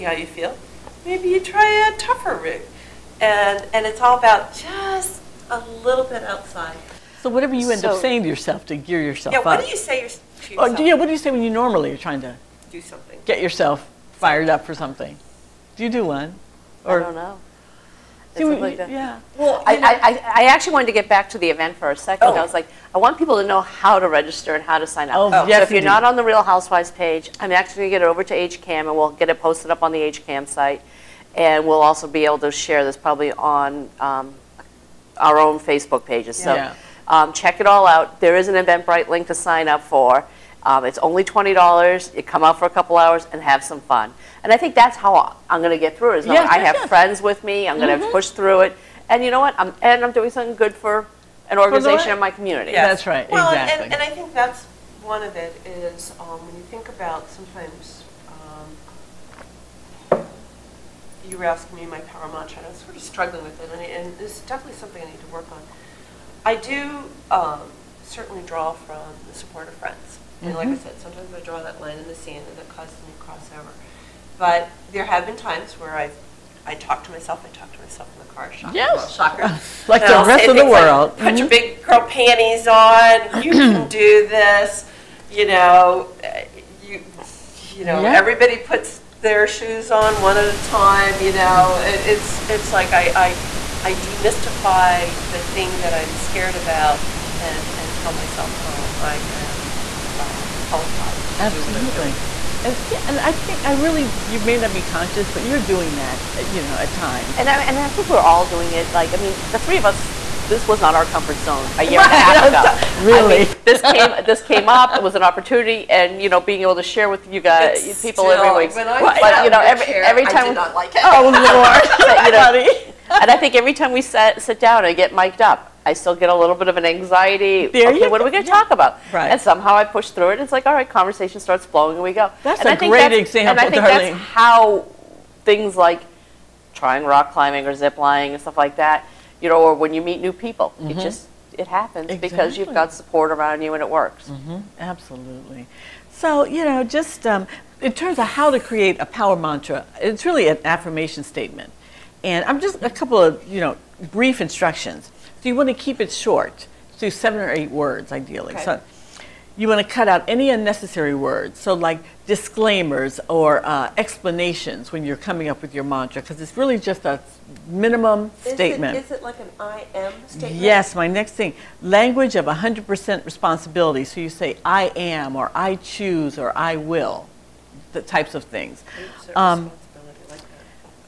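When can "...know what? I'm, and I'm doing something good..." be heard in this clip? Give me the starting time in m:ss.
0:49.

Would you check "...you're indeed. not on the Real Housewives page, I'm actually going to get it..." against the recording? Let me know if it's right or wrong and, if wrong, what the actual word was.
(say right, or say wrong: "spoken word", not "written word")
right.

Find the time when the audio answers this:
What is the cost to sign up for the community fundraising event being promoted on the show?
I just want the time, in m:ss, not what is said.
0:41.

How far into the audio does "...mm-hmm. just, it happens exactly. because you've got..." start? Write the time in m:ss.
2:20.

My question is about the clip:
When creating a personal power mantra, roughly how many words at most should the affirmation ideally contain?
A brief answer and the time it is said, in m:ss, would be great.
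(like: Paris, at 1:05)
8, at 2:37.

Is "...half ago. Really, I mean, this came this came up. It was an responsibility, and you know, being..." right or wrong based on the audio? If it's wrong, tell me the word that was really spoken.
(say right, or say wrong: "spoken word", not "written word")
wrong: "opportunity", not "responsibility".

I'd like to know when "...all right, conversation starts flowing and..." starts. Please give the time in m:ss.
2:10.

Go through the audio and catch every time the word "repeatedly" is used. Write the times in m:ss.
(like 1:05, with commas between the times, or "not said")
not said.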